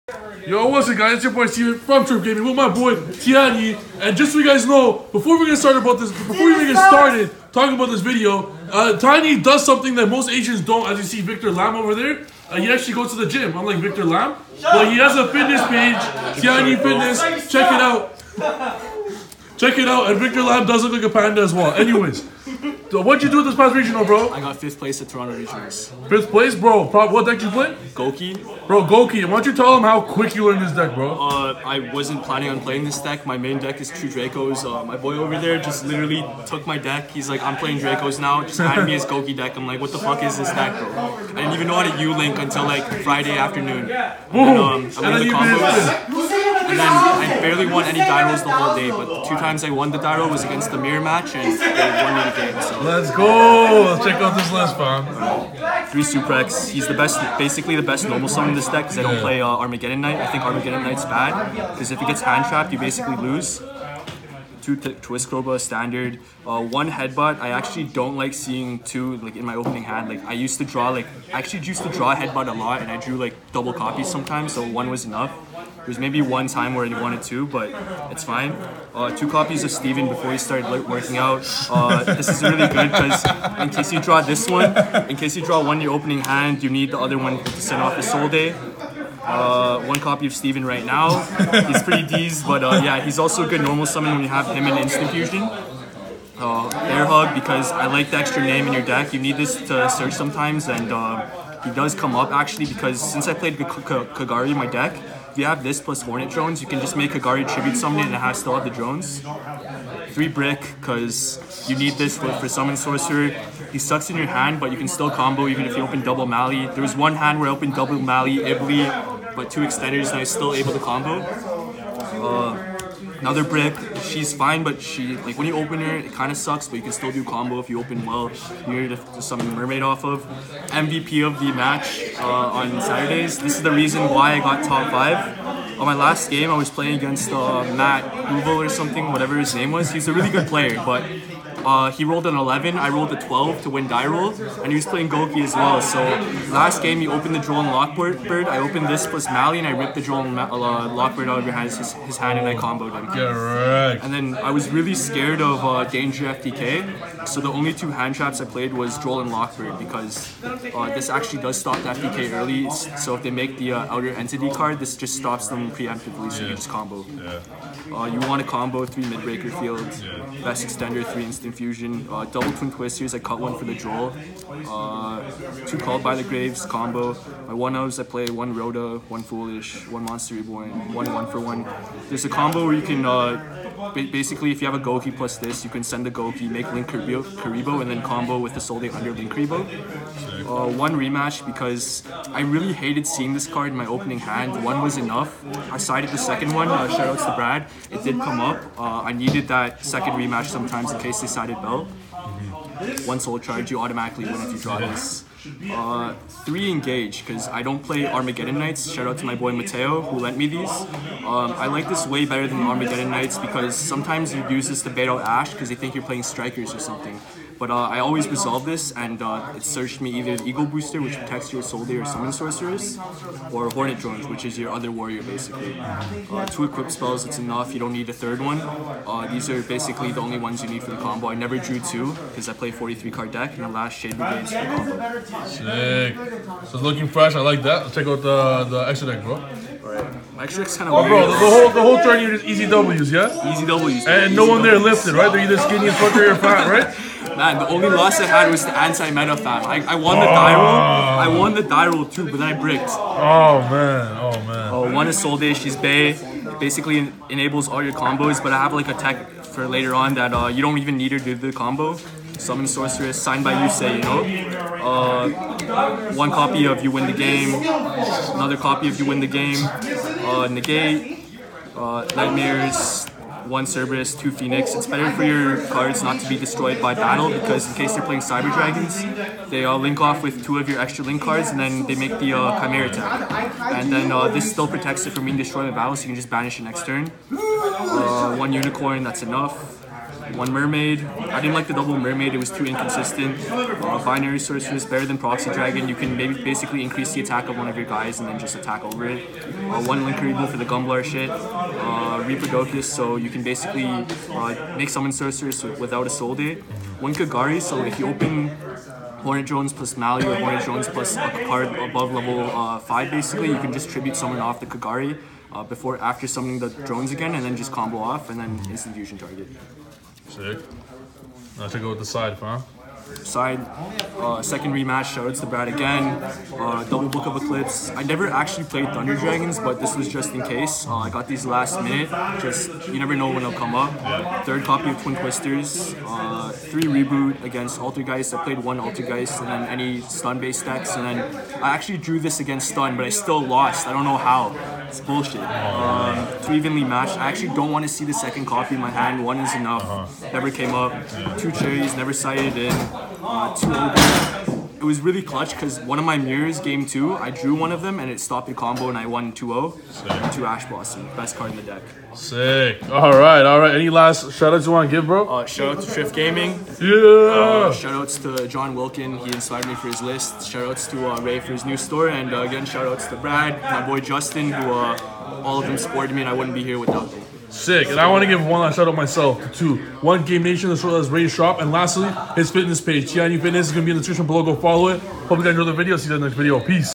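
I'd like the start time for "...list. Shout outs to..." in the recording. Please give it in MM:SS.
06:10.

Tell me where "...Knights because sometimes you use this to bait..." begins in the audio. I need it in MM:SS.
03:33.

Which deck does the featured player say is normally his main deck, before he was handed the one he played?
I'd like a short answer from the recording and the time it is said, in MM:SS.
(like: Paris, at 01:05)
True Dracos, at 00:33.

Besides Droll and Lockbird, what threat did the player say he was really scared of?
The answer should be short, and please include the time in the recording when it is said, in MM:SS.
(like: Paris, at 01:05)
Danger FTK, at 02:35.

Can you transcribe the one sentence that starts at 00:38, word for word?
Just handed me his Gouki deck.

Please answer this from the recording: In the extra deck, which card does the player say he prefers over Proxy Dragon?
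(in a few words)
Binary Sorceress.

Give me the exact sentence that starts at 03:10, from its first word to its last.
Uh, one rematch because I really hated seeing this card in my opening hand.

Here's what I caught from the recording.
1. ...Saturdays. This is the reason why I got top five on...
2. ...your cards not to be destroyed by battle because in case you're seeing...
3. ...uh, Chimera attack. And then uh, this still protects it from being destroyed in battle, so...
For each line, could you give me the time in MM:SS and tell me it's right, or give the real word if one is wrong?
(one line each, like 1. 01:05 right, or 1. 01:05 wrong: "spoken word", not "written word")
1. 02:12 right
2. 04:35 wrong: "playing", not "seeing"
3. 04:42 right.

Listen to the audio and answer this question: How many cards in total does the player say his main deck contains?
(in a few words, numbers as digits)
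43.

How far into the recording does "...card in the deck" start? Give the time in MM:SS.
06:01.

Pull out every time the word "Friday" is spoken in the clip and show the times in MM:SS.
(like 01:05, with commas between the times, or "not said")
00:43.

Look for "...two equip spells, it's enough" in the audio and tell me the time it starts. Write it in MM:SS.
03:46.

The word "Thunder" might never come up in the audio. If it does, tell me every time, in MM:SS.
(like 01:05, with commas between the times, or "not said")
05:28.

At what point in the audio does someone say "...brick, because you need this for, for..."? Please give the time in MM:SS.
01:50.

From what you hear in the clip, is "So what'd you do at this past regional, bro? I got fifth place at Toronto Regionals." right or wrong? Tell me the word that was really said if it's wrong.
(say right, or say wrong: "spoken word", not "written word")
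right.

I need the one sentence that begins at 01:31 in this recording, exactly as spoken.
he's pretty deez, but uh, yeah, he's also a good normal summon when you have him in Instant Fusion.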